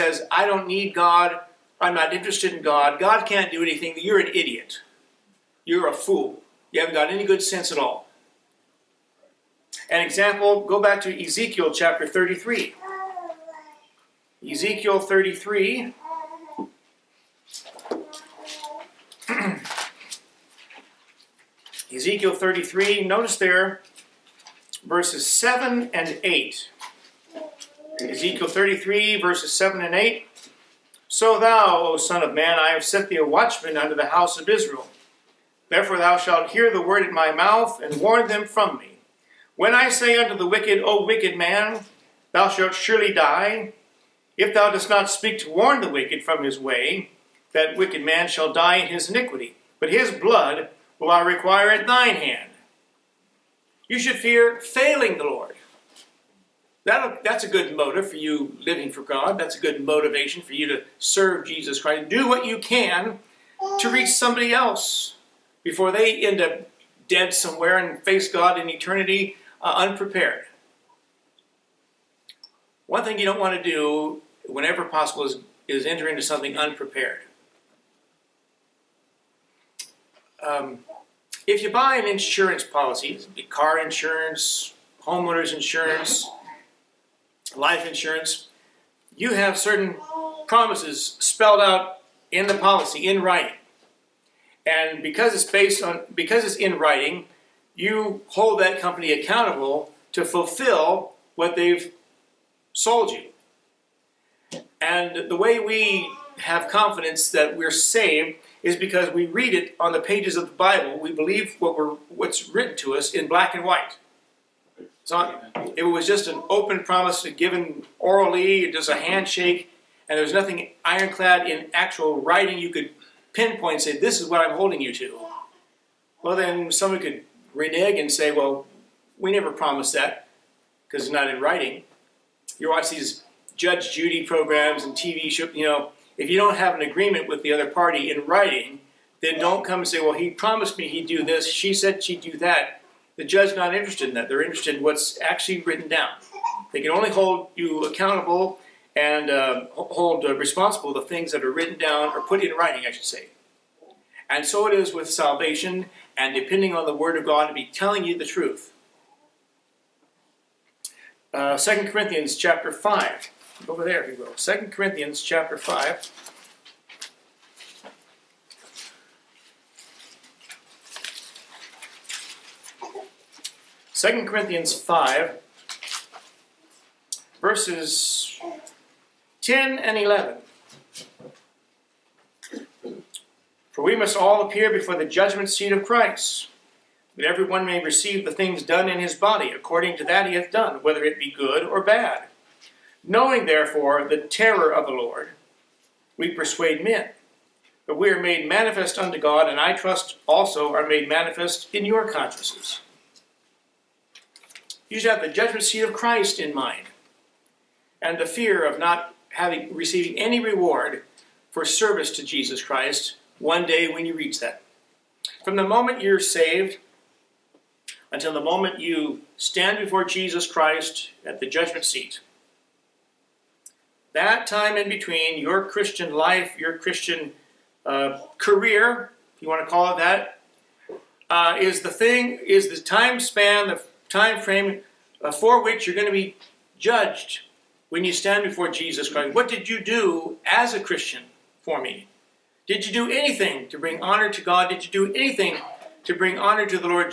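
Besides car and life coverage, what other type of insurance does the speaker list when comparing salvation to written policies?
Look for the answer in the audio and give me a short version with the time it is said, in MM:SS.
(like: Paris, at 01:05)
Homeowners insurance, at 01:25.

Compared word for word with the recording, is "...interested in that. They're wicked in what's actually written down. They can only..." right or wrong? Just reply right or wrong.
wrong.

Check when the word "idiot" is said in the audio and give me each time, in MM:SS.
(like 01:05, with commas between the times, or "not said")
00:04.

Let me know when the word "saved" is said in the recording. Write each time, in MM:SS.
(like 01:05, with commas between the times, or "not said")
01:47, 03:36.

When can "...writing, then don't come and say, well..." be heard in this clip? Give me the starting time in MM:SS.
02:18.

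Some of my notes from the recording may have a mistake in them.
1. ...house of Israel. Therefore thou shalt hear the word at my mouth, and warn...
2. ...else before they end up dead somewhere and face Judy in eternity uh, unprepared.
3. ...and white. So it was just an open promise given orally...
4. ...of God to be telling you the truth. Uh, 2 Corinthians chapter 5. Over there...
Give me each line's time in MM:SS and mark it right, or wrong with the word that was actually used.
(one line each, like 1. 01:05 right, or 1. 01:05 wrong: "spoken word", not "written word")
1. 00:34 right
2. 01:04 wrong: "God", not "Judy"
3. 01:53 right
4. 02:37 right.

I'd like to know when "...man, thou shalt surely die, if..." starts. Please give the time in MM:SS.
00:41.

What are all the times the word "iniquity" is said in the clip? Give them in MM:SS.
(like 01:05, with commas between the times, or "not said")
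00:49.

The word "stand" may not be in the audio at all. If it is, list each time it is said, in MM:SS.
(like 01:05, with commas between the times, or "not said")
03:39, 03:58.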